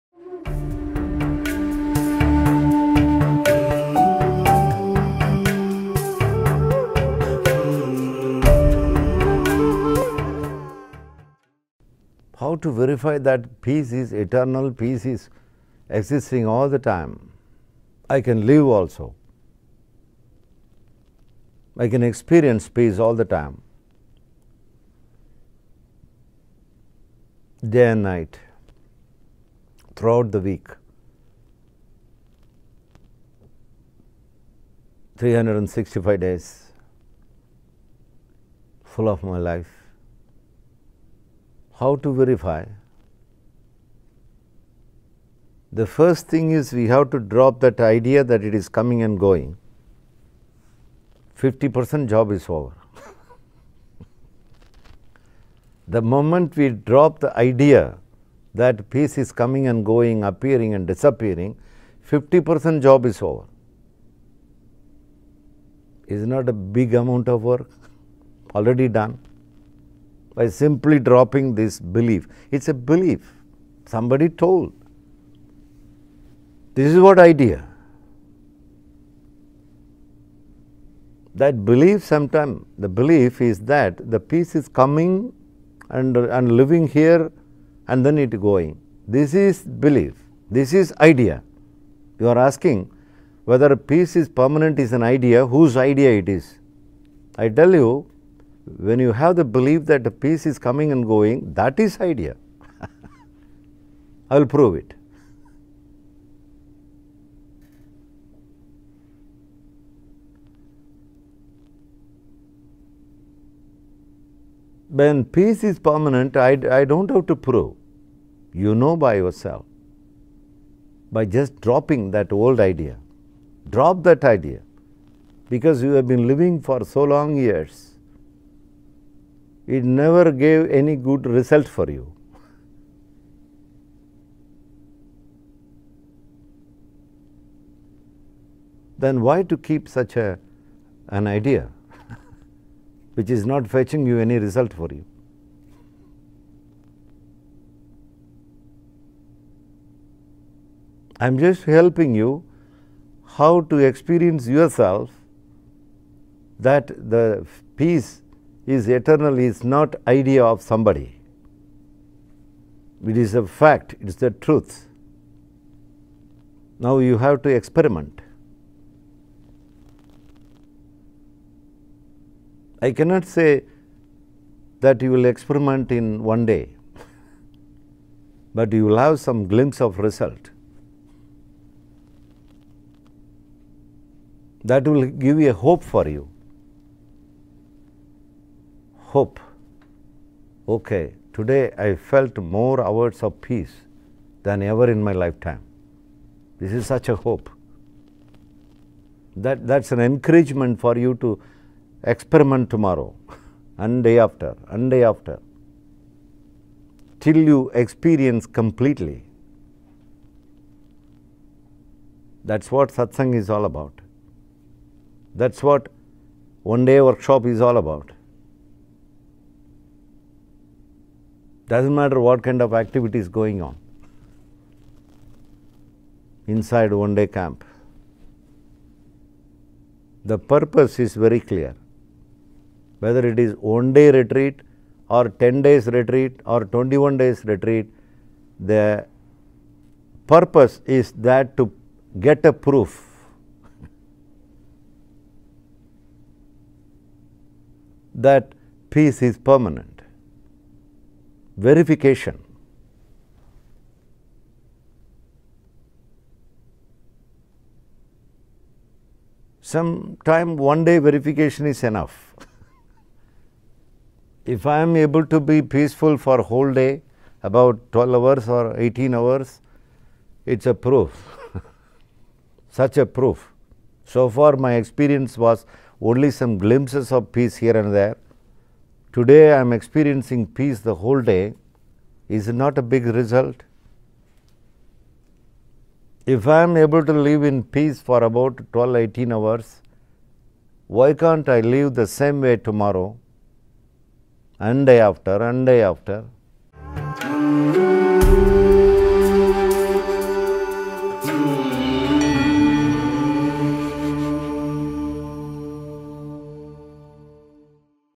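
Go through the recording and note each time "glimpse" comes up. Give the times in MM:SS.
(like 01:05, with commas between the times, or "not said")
02:59, 04:36.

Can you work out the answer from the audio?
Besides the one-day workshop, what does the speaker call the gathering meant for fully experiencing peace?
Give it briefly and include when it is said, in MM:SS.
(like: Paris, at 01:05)
satsang, at 03:32.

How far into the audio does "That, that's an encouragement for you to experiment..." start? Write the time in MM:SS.
03:19.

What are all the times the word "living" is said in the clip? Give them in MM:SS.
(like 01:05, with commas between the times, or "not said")
01:26, 02:06.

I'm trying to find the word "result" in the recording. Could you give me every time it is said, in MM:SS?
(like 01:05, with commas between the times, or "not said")
02:11, 02:24, 03:00, 04:43.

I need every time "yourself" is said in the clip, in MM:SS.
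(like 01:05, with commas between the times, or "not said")
01:59, 02:34.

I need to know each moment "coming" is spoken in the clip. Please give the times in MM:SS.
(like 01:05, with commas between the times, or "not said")
00:48, 00:59, 01:24, 01:40.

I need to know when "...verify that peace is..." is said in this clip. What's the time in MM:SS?
00:12.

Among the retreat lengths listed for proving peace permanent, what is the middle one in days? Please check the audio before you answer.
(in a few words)
10.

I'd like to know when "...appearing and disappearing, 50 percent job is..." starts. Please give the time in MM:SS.
01:00.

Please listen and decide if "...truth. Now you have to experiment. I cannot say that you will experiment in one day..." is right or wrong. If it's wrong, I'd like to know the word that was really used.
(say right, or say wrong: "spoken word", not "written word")
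right.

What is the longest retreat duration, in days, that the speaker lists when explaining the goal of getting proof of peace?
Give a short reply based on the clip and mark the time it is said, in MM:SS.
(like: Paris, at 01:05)
21, at 03:56.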